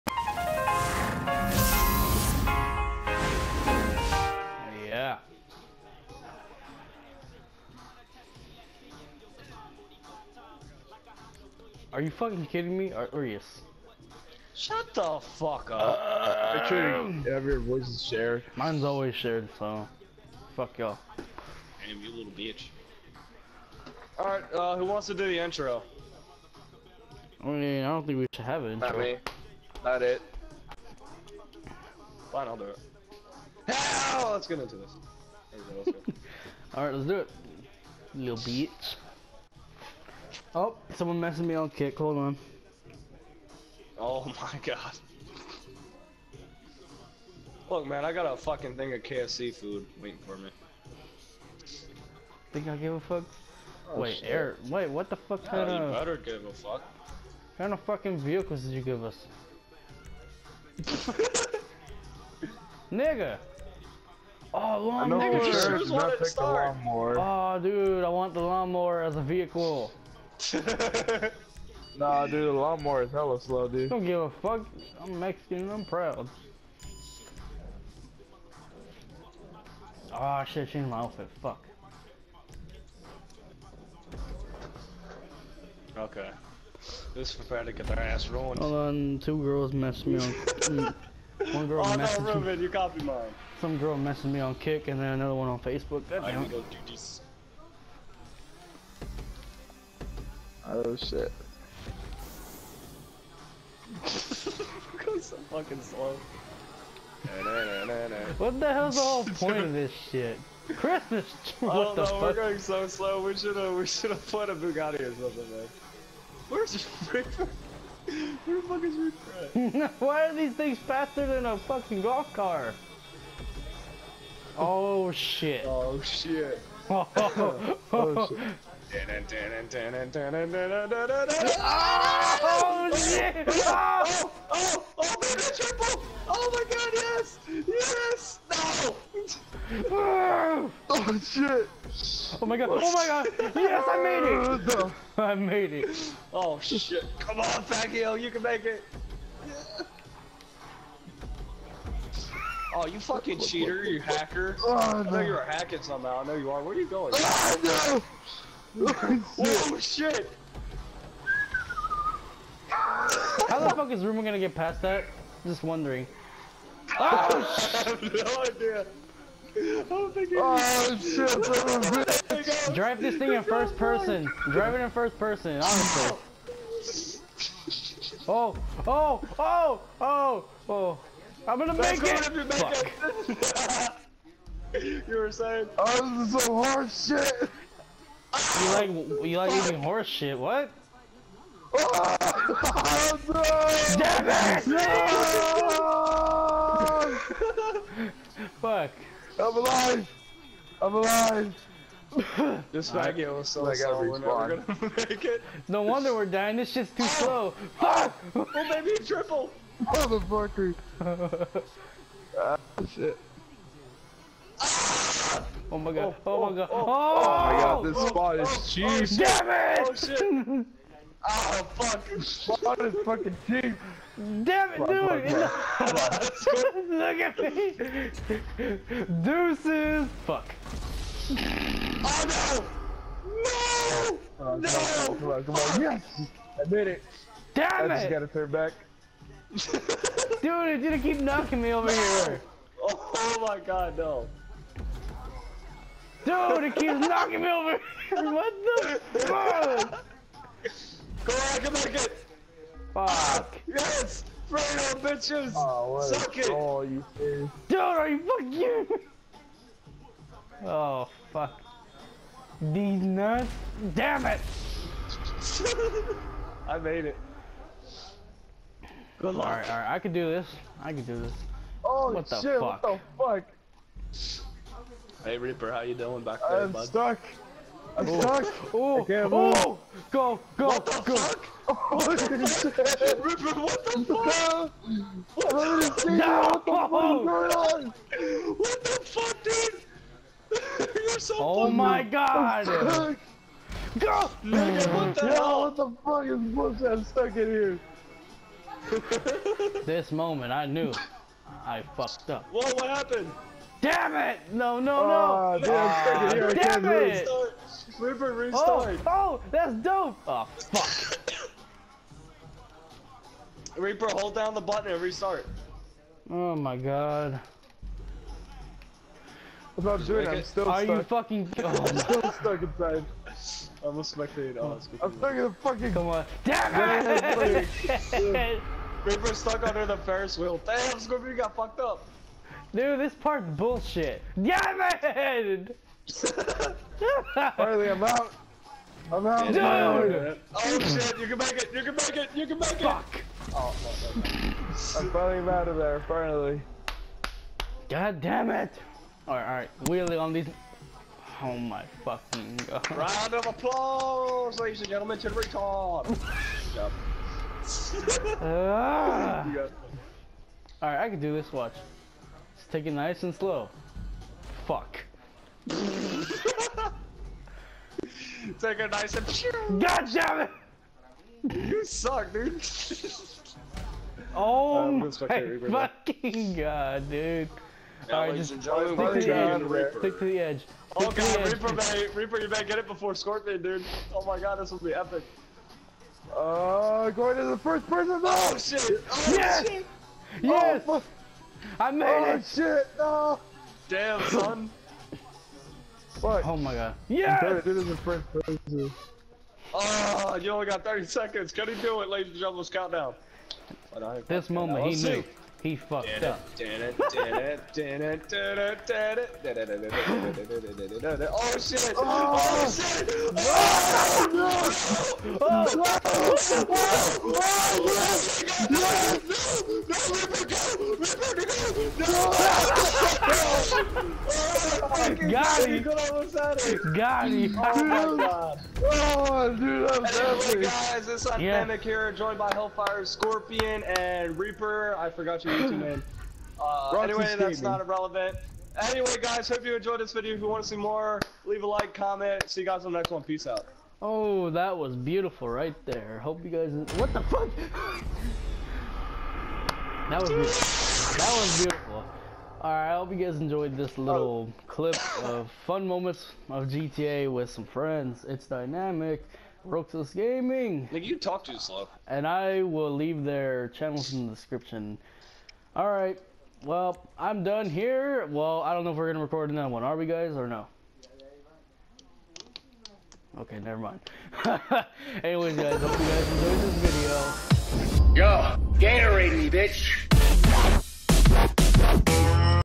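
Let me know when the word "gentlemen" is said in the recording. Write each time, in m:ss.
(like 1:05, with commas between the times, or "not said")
5:54, 6:42.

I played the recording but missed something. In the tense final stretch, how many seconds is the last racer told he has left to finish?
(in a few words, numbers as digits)
30.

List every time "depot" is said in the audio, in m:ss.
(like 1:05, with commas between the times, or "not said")
not said.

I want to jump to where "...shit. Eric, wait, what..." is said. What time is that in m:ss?
0:54.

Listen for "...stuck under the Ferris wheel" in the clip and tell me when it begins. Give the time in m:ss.
5:29.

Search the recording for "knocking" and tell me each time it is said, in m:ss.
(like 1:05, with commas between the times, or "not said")
4:01, 4:06.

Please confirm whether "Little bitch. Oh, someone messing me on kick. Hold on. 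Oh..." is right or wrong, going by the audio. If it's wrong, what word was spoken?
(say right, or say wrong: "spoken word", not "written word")
right.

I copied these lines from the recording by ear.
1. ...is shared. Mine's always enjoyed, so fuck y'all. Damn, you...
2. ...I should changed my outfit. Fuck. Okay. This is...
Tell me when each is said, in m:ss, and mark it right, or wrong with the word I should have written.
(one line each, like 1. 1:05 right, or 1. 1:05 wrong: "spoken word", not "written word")
1. 0:17 wrong: "shared", not "enjoyed"
2. 1:20 right.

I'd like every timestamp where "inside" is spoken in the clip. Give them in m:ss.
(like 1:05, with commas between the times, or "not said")
5:22.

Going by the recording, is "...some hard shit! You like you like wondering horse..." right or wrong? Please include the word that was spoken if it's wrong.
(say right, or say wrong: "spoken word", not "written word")
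wrong: "eating", not "wondering".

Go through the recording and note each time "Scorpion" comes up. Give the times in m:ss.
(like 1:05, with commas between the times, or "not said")
5:30, 6:23, 7:13.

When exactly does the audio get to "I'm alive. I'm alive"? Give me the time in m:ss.
3:19.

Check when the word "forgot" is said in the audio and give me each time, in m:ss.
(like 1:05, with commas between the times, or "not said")
7:15.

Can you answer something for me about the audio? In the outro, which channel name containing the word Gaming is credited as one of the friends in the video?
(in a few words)
Roxas Gaming.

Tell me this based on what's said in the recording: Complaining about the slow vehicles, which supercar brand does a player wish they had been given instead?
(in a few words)
Bugatti.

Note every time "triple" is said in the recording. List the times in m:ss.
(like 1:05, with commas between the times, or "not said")
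2:15, 3:29.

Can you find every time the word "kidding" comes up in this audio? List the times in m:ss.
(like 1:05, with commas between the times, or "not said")
0:12.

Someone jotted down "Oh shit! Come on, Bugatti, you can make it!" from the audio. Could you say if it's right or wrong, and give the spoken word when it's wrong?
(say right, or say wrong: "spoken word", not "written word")
wrong: "Pacquiao", not "Bugatti".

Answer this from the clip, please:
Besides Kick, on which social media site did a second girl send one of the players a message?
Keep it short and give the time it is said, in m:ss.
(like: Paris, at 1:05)
Facebook, at 1:35.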